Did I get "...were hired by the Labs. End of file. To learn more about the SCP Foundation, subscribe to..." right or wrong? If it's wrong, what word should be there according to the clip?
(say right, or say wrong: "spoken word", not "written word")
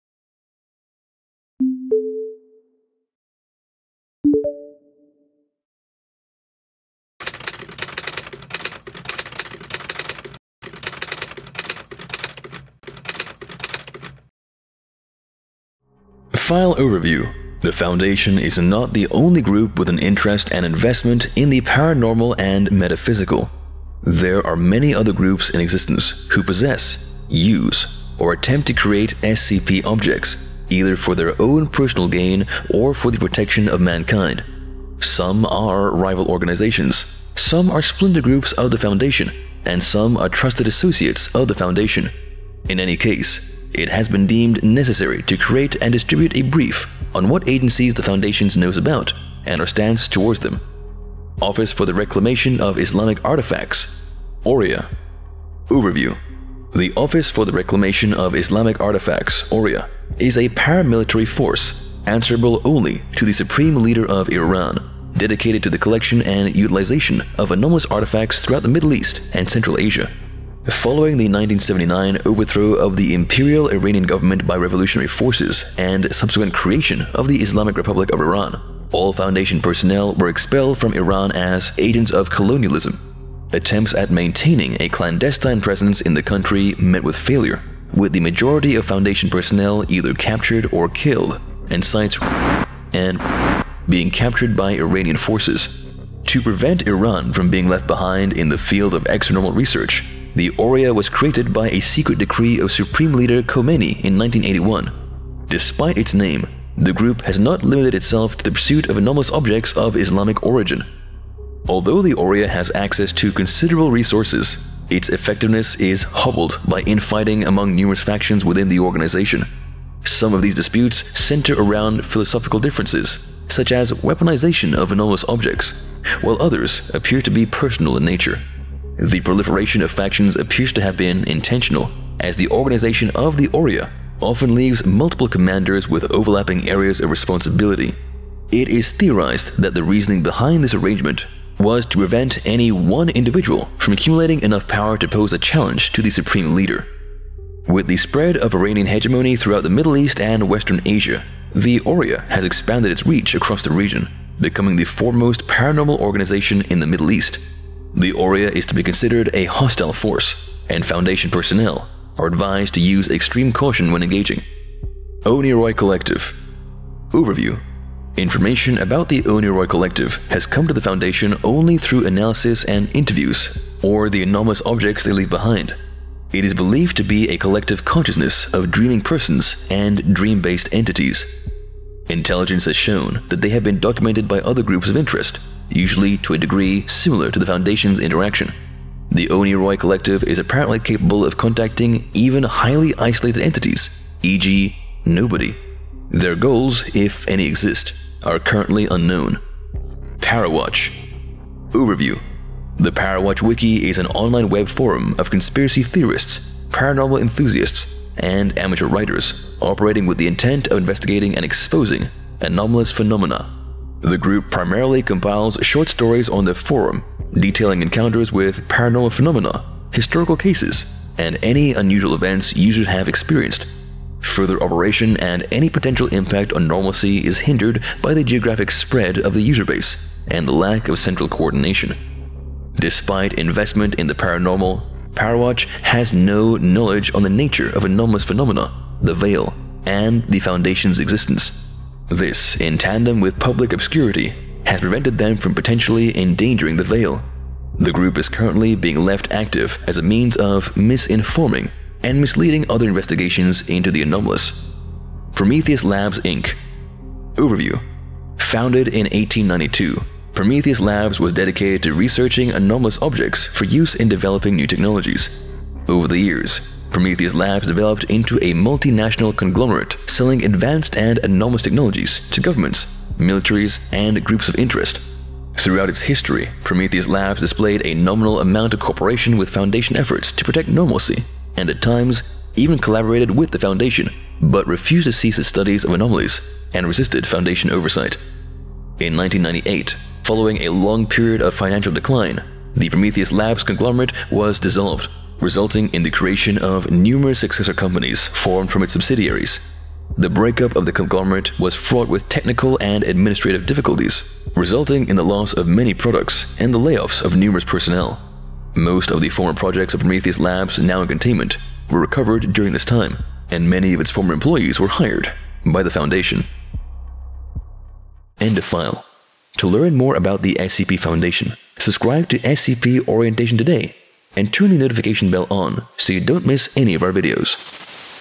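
wrong: "Foundation", not "Labs".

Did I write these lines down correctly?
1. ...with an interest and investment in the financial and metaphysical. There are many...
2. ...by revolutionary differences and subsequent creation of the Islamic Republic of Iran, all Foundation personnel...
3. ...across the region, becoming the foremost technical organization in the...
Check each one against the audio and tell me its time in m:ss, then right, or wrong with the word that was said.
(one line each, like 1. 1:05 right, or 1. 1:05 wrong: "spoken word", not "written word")
1. 0:19 wrong: "paranormal", not "financial"
2. 1:14 wrong: "forces", not "differences"
3. 2:33 wrong: "paranormal", not "technical".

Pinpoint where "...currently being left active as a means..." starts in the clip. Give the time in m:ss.
4:08.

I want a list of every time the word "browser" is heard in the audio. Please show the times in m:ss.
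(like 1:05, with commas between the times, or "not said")
not said.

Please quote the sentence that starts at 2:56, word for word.
It is believed to be a collective consciousness of dreaming persons and dream based entities.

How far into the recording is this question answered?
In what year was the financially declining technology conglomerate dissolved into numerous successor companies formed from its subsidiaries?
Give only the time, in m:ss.
4:49.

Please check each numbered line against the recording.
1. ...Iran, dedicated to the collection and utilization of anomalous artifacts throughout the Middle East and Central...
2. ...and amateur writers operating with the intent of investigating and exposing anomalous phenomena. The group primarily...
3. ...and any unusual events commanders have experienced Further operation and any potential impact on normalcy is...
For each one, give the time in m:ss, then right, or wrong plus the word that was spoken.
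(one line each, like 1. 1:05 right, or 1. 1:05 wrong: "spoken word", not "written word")
1. 1:04 right
2. 3:28 right
3. 3:41 wrong: "users", not "commanders".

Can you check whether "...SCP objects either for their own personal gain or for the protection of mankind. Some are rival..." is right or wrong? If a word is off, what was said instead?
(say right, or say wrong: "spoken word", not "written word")
right.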